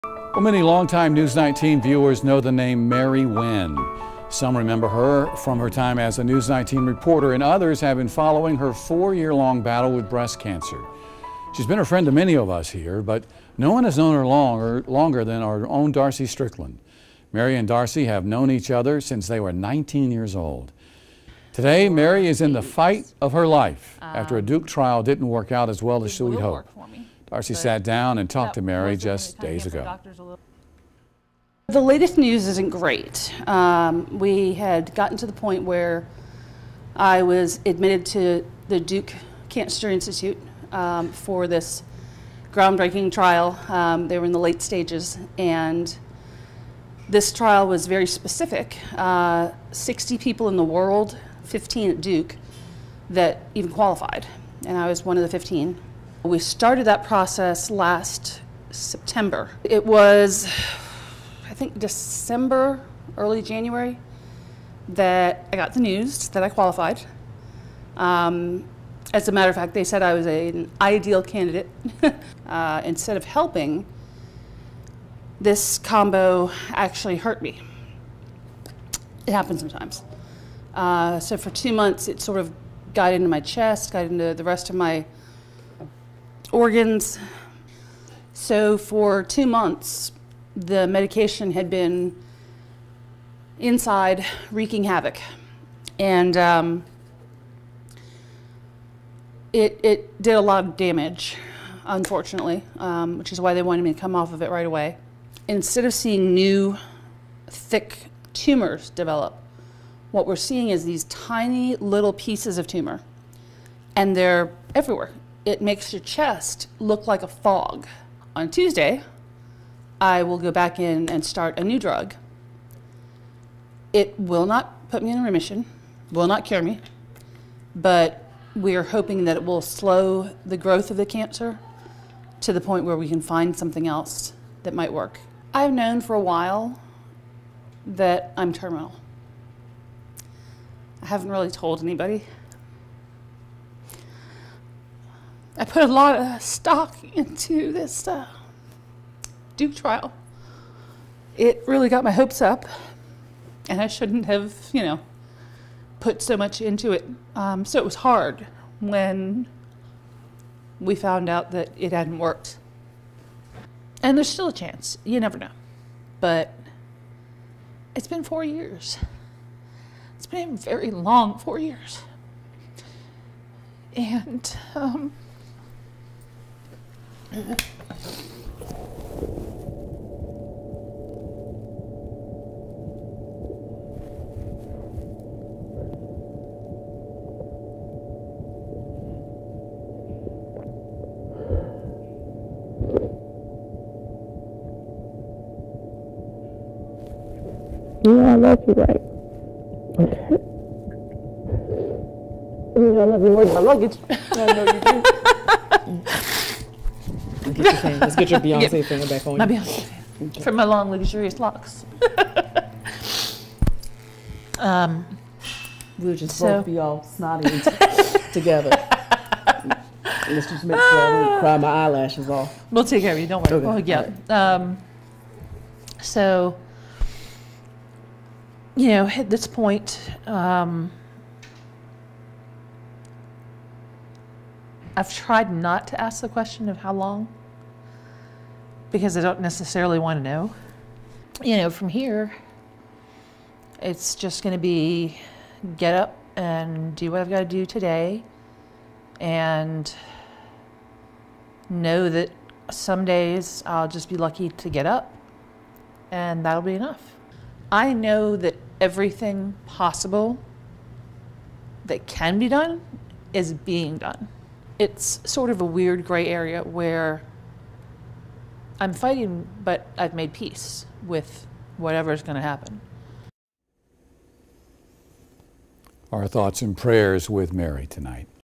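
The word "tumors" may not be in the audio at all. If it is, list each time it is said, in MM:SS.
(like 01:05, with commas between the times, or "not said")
01:48, 01:52.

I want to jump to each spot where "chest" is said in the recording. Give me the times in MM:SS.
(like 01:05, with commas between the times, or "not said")
01:23, 01:56.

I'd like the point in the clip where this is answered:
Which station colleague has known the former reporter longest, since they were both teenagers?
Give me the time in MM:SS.
00:15.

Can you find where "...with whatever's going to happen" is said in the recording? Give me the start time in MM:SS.
04:31.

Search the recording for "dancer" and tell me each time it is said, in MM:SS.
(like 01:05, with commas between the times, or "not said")
not said.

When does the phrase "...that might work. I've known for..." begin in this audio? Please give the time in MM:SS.
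02:14.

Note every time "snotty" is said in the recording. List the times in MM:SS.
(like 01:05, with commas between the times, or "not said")
03:37.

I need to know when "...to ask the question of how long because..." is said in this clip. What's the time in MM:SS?
03:55.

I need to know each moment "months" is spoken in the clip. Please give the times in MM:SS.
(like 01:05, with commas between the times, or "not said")
01:21, 01:29.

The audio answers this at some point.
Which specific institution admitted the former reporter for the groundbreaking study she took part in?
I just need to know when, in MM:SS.
00:38.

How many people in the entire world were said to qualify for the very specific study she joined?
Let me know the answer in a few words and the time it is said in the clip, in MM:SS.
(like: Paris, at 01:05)
60, at 00:49.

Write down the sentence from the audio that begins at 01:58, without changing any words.
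On Tuesday, I will go back in and start a new drug.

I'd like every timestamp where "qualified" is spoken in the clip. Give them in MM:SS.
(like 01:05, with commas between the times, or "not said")
00:53, 01:06.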